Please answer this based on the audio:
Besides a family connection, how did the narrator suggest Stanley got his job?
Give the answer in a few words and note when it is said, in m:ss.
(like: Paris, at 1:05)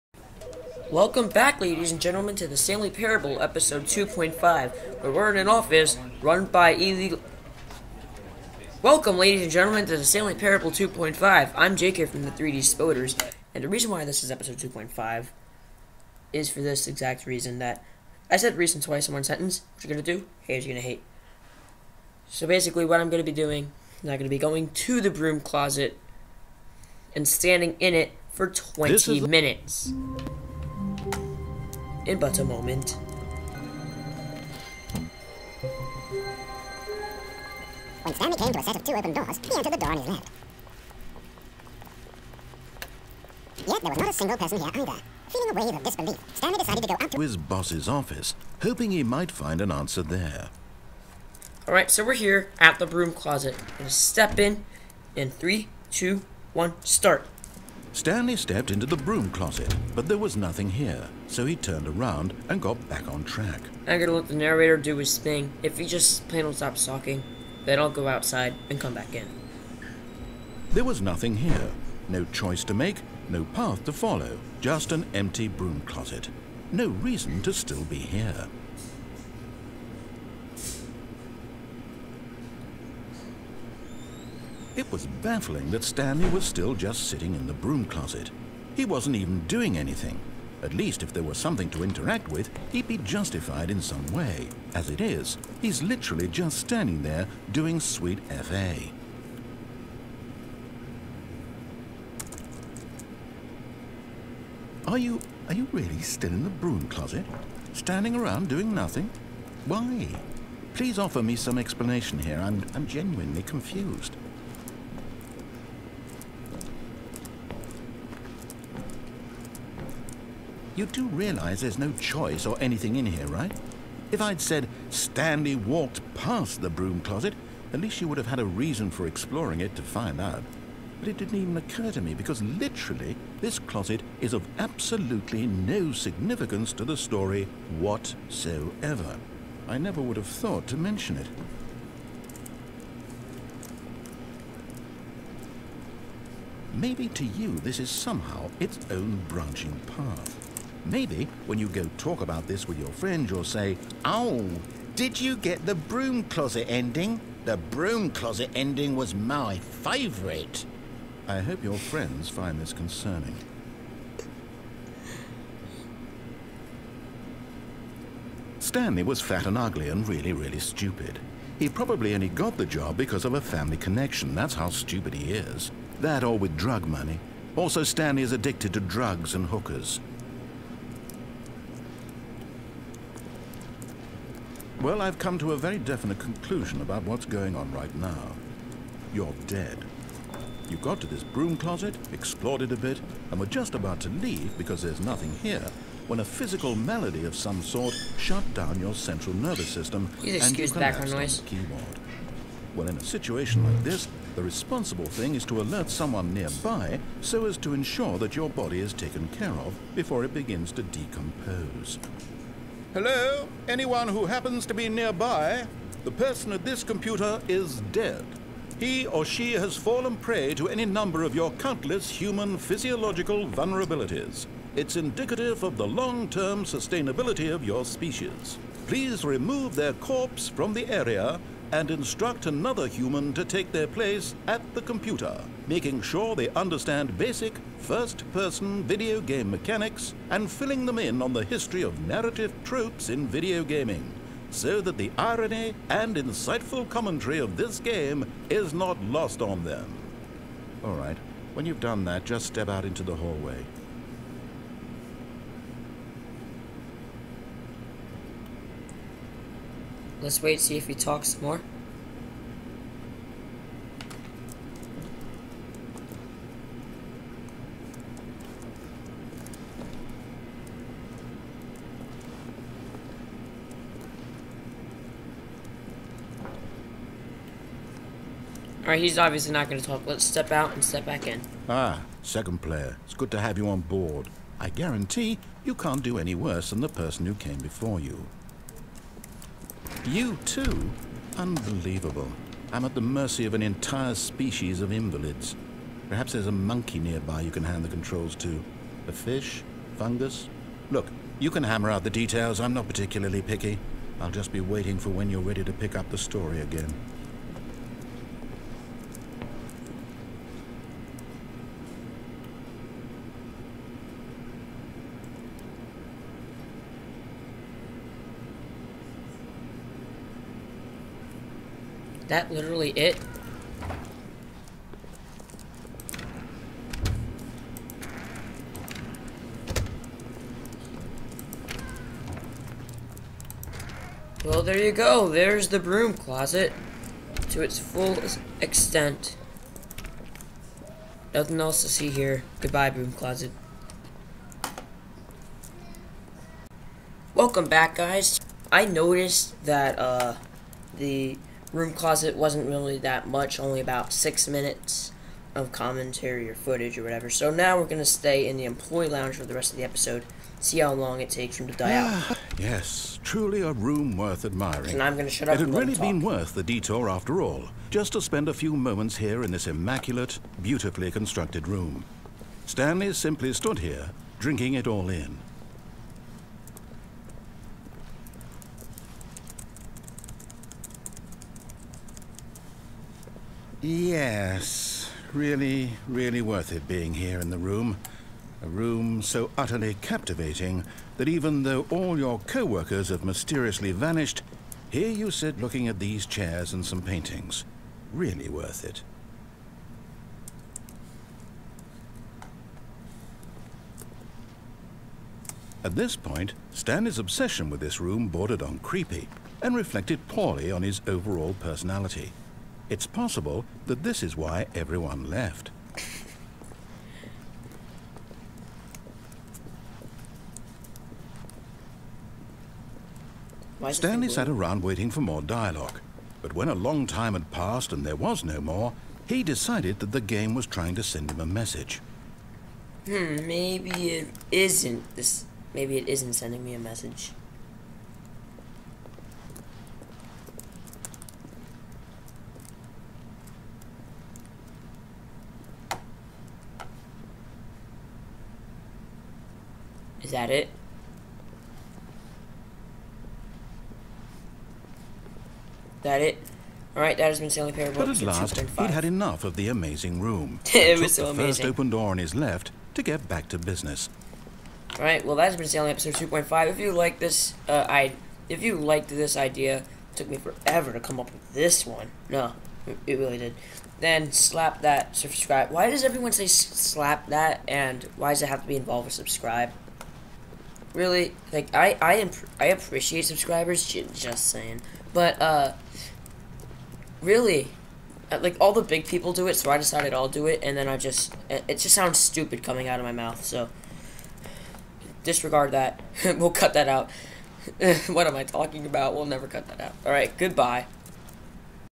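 drug money, at 2:56.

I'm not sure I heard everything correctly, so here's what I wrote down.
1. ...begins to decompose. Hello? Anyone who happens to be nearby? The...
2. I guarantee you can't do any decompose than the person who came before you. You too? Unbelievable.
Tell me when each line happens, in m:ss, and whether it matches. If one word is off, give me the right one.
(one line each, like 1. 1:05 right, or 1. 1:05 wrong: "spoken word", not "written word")
1. 3:30 right
2. 4:44 wrong: "worse", not "decompose".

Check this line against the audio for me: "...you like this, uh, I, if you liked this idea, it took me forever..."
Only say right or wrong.
right.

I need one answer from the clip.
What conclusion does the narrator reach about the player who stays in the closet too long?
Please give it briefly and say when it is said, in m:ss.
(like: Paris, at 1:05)
You're dead, at 3:09.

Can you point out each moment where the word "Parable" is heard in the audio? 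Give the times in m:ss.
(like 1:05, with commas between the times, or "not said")
0:02, 0:10, 7:37.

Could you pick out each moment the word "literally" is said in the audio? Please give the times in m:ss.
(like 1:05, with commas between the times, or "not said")
1:35, 2:12, 5:22.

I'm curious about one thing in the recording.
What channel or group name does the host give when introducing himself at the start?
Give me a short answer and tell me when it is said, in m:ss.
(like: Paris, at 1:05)
3D Spoders, at 0:12.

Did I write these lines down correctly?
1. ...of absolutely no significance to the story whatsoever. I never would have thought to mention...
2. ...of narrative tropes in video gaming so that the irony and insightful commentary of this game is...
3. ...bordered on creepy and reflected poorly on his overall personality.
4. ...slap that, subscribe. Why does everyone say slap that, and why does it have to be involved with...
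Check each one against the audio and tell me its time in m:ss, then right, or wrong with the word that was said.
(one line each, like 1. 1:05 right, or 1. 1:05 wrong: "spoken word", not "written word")
1. 2:14 right
2. 4:01 right
3. 6:48 right
4. 7:54 right.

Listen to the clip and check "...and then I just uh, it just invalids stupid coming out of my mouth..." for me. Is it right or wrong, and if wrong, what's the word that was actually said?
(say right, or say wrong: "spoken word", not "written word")
wrong: "sounds", not "invalids".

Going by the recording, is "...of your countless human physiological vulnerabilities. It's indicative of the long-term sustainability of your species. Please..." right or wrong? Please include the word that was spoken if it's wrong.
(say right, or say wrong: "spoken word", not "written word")
right.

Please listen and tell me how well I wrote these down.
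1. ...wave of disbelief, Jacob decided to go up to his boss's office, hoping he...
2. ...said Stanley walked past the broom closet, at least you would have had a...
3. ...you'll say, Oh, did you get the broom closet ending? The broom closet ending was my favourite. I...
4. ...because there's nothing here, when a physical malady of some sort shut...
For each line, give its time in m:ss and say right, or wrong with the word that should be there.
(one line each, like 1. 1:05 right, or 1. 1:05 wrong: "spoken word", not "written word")
1. 0:45 wrong: "Stanley", not "Jacob"
2. 2:04 right
3. 2:33 right
4. 3:14 right.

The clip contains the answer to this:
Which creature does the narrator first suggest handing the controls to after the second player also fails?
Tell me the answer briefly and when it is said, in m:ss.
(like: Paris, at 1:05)
a monkey, at 4:56.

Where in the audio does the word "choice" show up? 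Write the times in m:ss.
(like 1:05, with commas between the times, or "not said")
1:12, 2:01.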